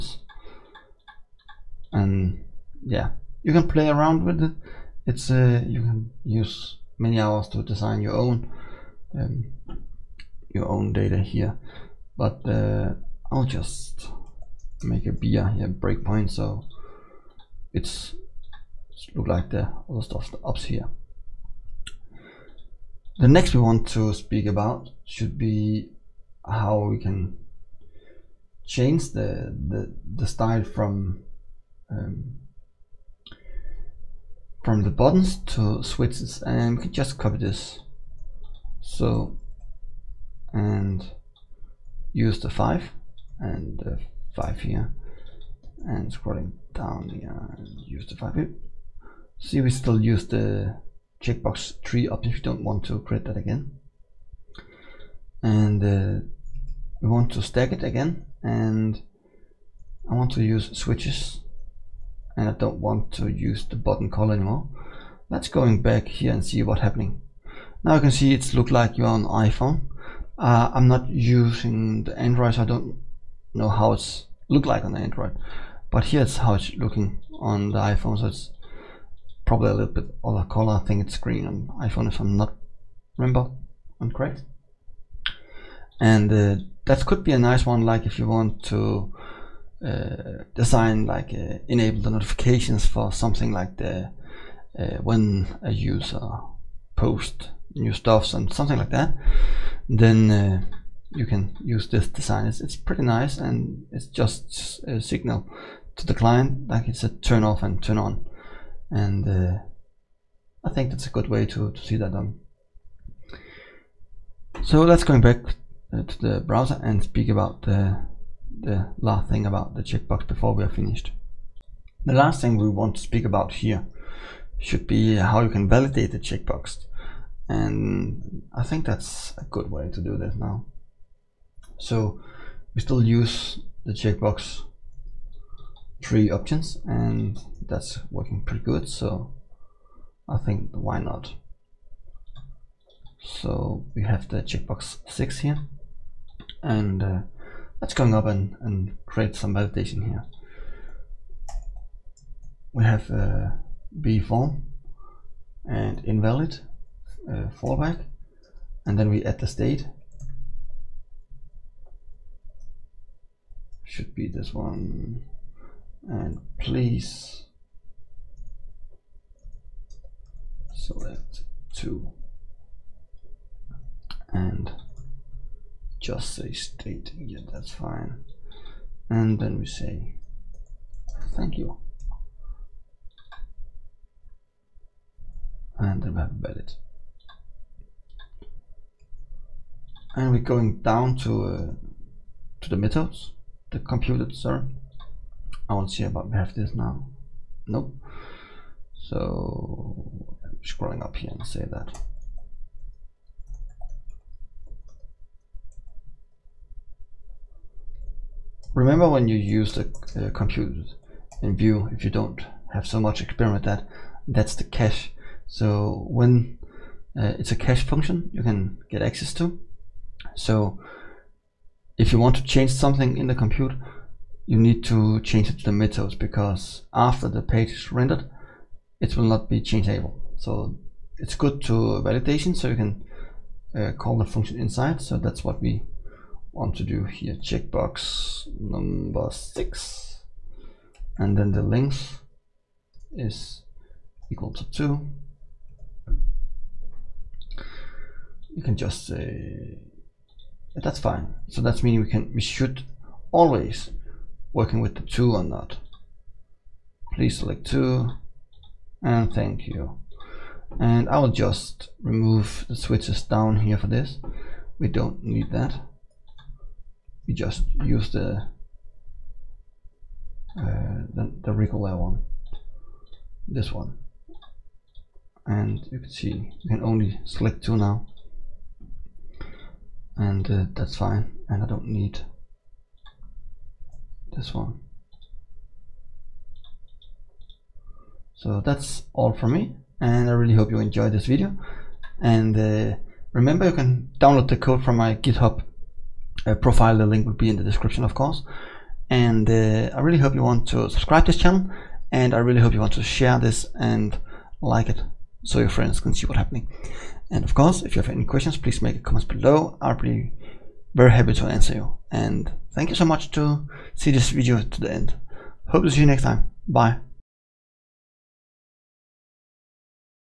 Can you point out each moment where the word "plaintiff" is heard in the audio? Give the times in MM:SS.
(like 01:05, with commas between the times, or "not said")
not said.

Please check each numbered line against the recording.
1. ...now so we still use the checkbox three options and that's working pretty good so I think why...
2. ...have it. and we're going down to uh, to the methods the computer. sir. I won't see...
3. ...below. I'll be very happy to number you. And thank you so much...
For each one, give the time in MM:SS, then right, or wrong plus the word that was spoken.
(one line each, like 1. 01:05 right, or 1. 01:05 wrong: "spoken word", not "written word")
1. 02:10 right
2. 03:06 right
3. 05:09 wrong: "answer", not "number".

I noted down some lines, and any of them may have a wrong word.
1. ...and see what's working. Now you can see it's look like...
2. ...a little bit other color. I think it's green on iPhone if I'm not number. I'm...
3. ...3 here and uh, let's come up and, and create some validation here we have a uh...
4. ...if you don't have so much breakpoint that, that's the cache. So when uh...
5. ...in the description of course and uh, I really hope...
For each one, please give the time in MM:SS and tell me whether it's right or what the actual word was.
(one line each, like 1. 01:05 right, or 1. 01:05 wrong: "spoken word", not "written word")
1. 01:06 wrong: "happening", not "working"
2. 01:19 wrong: "remember", not "number"
3. 02:25 wrong: "6", not "3"
4. 03:31 wrong: "experiment", not "breakpoint"
5. 04:57 right.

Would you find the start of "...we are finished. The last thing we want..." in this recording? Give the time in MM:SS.
02:00.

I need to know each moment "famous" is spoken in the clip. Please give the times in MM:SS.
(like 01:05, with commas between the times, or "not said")
not said.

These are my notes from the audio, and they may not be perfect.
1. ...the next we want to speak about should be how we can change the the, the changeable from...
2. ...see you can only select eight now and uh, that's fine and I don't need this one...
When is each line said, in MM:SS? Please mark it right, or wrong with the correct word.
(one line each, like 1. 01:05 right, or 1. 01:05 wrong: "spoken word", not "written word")
1. 00:23 wrong: "style", not "changeable"
2. 04:36 wrong: "two", not "eight".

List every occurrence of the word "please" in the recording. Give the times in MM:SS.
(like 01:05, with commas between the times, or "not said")
02:46, 04:17, 05:08.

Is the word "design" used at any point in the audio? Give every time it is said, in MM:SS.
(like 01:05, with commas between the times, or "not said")
00:07, 01:30, 01:42.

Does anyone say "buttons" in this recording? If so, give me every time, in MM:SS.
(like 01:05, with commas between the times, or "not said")
00:34, 01:03.